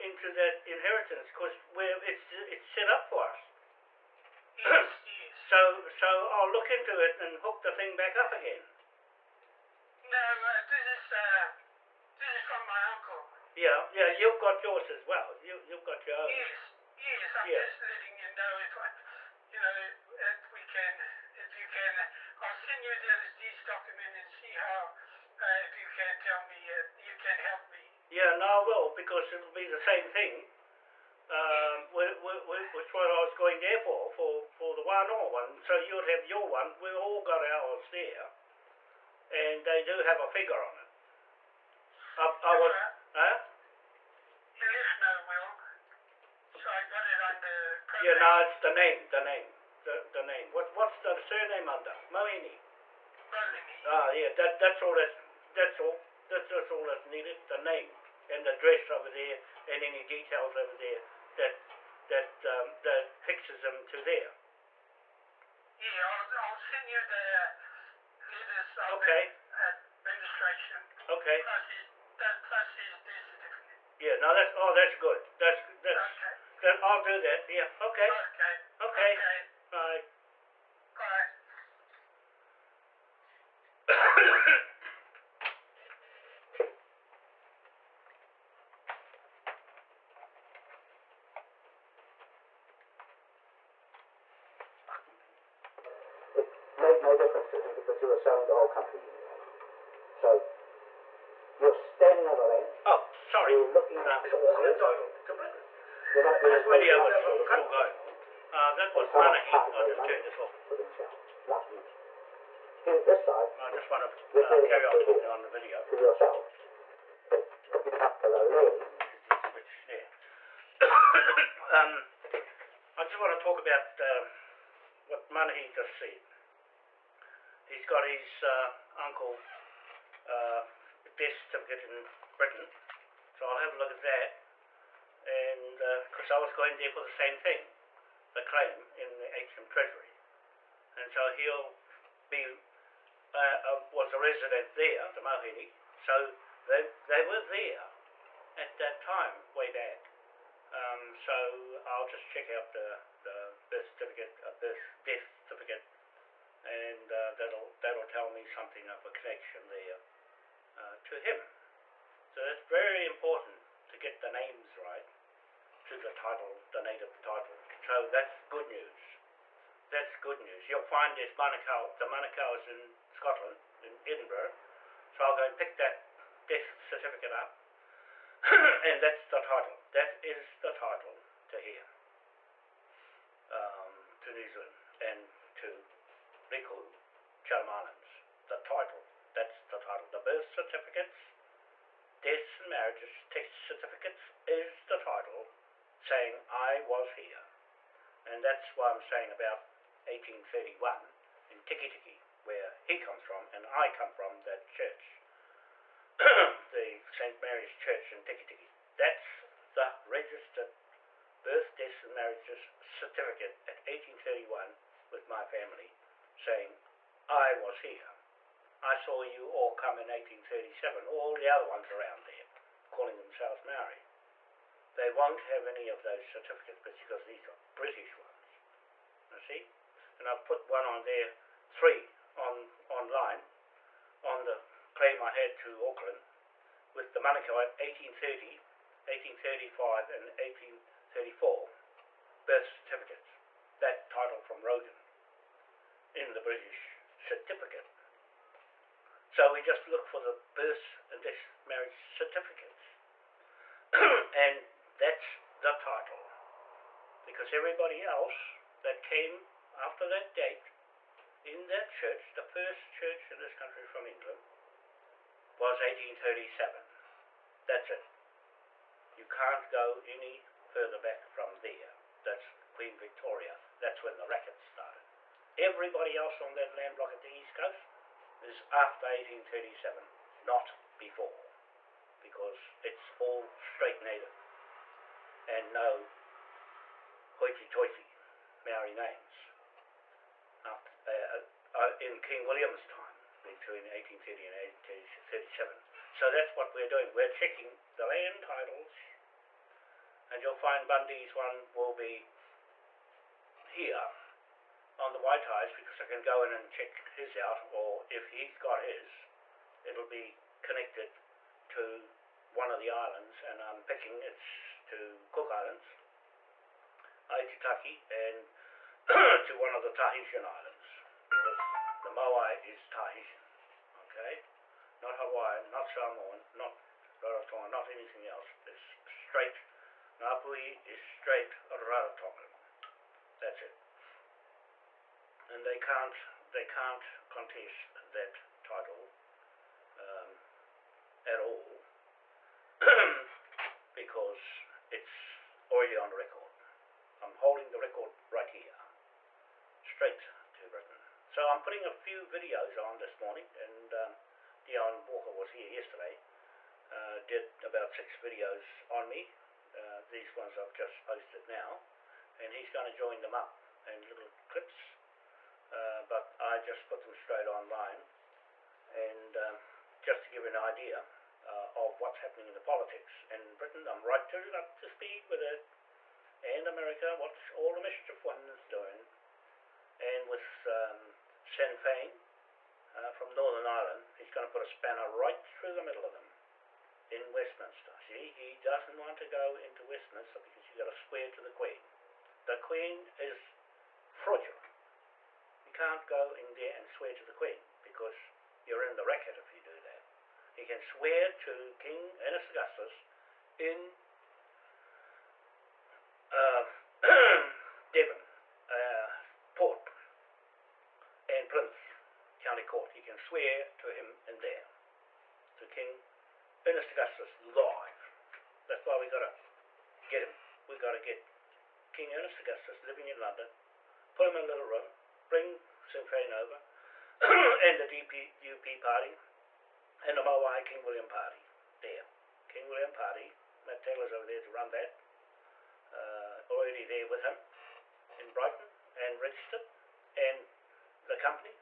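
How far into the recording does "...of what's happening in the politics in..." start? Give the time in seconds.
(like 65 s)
371 s.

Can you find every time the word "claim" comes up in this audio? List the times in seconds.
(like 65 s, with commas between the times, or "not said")
138 s, 234 s.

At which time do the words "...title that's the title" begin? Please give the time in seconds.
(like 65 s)
188 s.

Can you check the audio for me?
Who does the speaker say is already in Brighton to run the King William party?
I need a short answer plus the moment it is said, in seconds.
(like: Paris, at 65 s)
Matt Taylor, at 433 s.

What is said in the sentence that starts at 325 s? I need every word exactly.
Not Hawaiian, not Samoan, not Rarotonga, not anything else.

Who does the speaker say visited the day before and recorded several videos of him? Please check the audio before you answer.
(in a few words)
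Dion Walker.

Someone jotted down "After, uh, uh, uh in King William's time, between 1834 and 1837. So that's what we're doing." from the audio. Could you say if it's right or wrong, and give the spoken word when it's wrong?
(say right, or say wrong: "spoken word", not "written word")
wrong: "1830", not "1834".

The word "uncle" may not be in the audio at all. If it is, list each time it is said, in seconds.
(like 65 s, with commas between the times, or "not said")
12 s, 128 s.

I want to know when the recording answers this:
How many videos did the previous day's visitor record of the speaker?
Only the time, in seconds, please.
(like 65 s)
357 s.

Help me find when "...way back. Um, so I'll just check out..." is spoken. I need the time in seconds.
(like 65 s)
149 s.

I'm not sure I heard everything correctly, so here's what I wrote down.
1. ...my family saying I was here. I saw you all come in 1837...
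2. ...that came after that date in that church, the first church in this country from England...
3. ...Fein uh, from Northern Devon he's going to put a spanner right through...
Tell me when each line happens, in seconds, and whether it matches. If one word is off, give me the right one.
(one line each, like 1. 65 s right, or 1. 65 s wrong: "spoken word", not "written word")
1. 215 s right
2. 258 s right
3. 381 s wrong: "Ireland", not "Devon".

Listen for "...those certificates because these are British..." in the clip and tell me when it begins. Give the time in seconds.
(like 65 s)
226 s.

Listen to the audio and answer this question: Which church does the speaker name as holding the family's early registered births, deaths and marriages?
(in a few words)
St. Mary's Church.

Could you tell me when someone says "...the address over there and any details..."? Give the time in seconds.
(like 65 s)
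58 s.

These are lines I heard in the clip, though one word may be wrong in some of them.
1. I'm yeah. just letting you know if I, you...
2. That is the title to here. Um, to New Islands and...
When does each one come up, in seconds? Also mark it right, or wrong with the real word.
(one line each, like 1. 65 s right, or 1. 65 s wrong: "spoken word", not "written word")
1. 17 s right
2. 179 s wrong: "Zealand", not "Islands".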